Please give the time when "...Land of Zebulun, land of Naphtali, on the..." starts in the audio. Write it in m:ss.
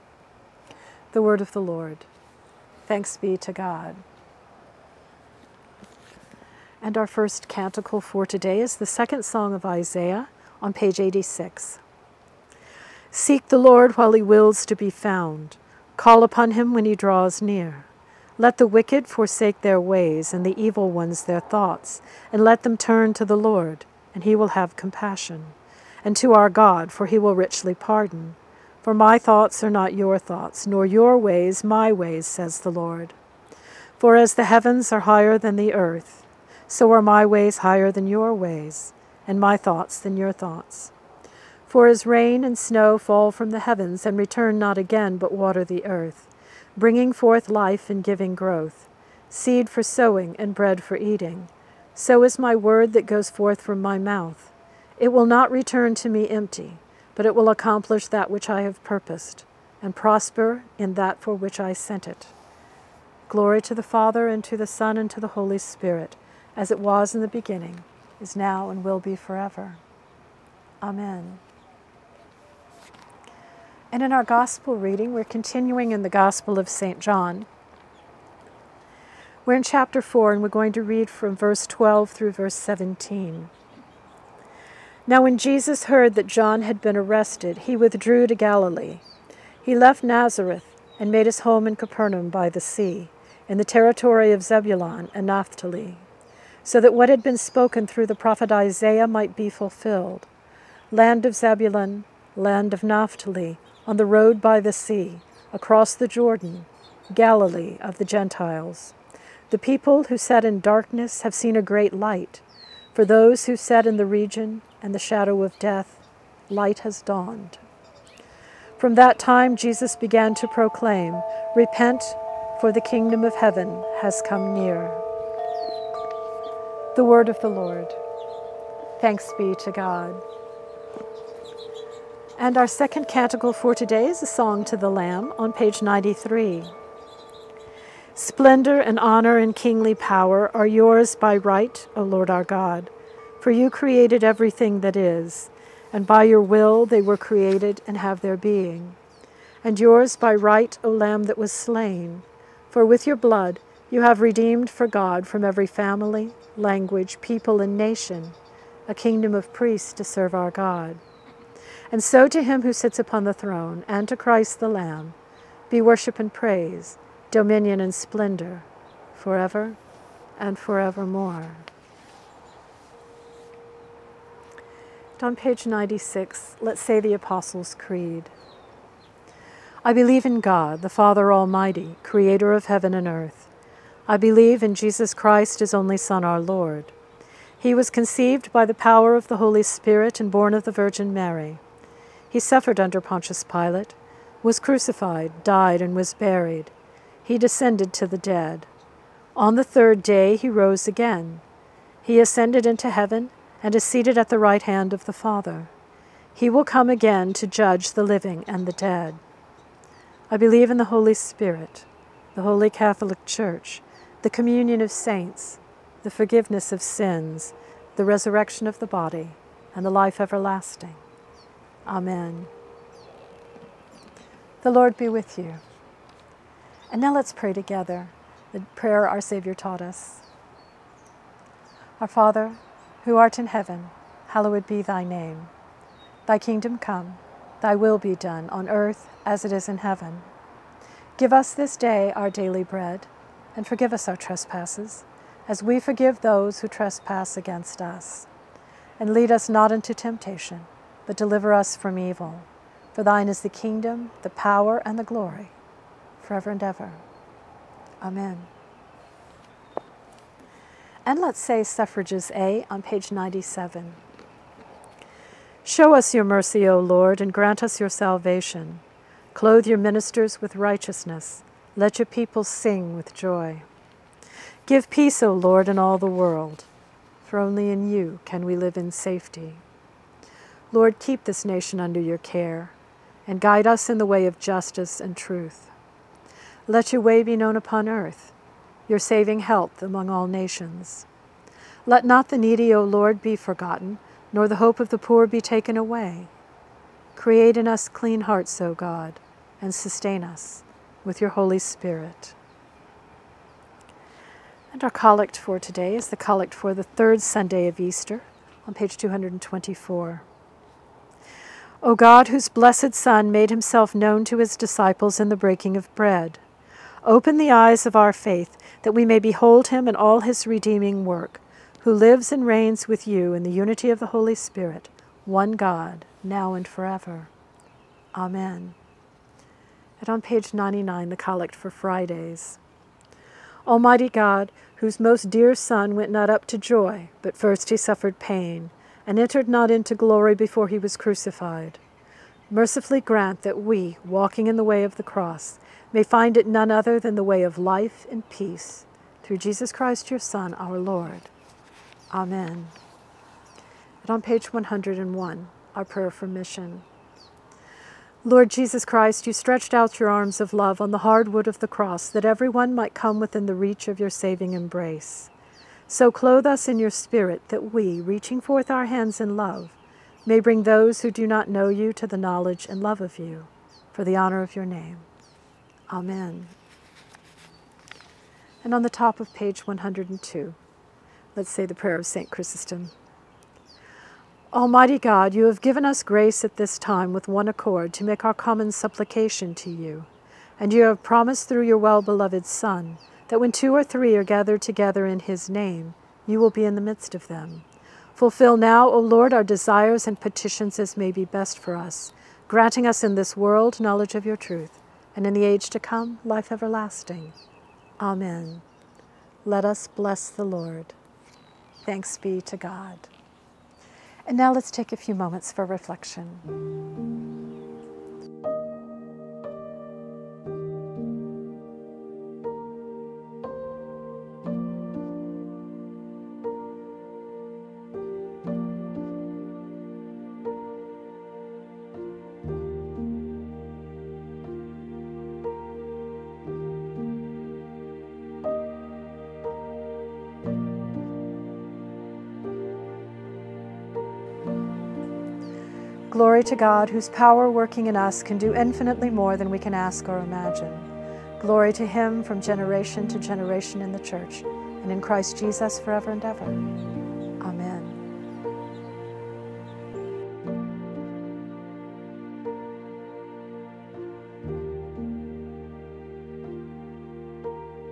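1:40.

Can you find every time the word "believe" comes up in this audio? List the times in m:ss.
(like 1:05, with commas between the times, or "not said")
2:59, 3:04, 3:30.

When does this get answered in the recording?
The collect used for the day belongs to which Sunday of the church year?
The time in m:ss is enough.
5:06.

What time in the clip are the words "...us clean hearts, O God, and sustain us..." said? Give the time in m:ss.
4:57.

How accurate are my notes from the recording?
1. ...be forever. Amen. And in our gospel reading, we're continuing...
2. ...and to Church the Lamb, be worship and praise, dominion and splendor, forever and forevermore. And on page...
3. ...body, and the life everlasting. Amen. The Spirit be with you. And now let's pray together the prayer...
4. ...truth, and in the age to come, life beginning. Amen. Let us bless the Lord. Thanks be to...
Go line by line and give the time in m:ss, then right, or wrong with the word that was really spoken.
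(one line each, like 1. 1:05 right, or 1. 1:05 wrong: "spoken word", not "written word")
1. 1:08 right
2. 2:43 wrong: "Christ", not "Church"
3. 3:38 wrong: "Lord", not "Spirit"
4. 6:44 wrong: "everlasting", not "beginning".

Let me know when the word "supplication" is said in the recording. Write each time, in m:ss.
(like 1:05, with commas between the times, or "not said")
6:28.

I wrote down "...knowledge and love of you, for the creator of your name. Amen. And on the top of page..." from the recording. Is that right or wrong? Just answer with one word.
wrong.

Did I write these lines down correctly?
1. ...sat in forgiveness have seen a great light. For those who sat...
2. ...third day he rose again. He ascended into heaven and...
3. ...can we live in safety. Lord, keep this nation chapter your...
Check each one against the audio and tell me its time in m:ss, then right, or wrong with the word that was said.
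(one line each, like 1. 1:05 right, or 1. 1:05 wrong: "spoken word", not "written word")
1. 1:50 wrong: "darkness", not "forgiveness"
2. 3:19 right
3. 4:38 wrong: "under", not "chapter".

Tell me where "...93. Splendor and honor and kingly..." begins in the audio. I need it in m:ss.
2:15.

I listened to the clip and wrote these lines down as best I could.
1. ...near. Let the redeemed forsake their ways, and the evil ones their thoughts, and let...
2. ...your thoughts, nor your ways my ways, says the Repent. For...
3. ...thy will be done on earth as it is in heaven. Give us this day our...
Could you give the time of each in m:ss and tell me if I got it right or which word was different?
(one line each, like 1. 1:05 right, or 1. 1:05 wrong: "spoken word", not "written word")
1. 0:17 wrong: "wicked", not "redeemed"
2. 0:29 wrong: "Lord", not "Repent"
3. 3:57 right.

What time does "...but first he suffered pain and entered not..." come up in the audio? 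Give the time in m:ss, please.
5:37.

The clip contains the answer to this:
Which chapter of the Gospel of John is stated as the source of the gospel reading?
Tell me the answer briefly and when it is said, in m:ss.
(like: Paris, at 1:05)
Chapter 4, at 1:19.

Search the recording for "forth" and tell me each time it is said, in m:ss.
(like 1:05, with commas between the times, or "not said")
0:47, 0:53, 6:08.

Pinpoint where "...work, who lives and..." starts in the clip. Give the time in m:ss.
5:21.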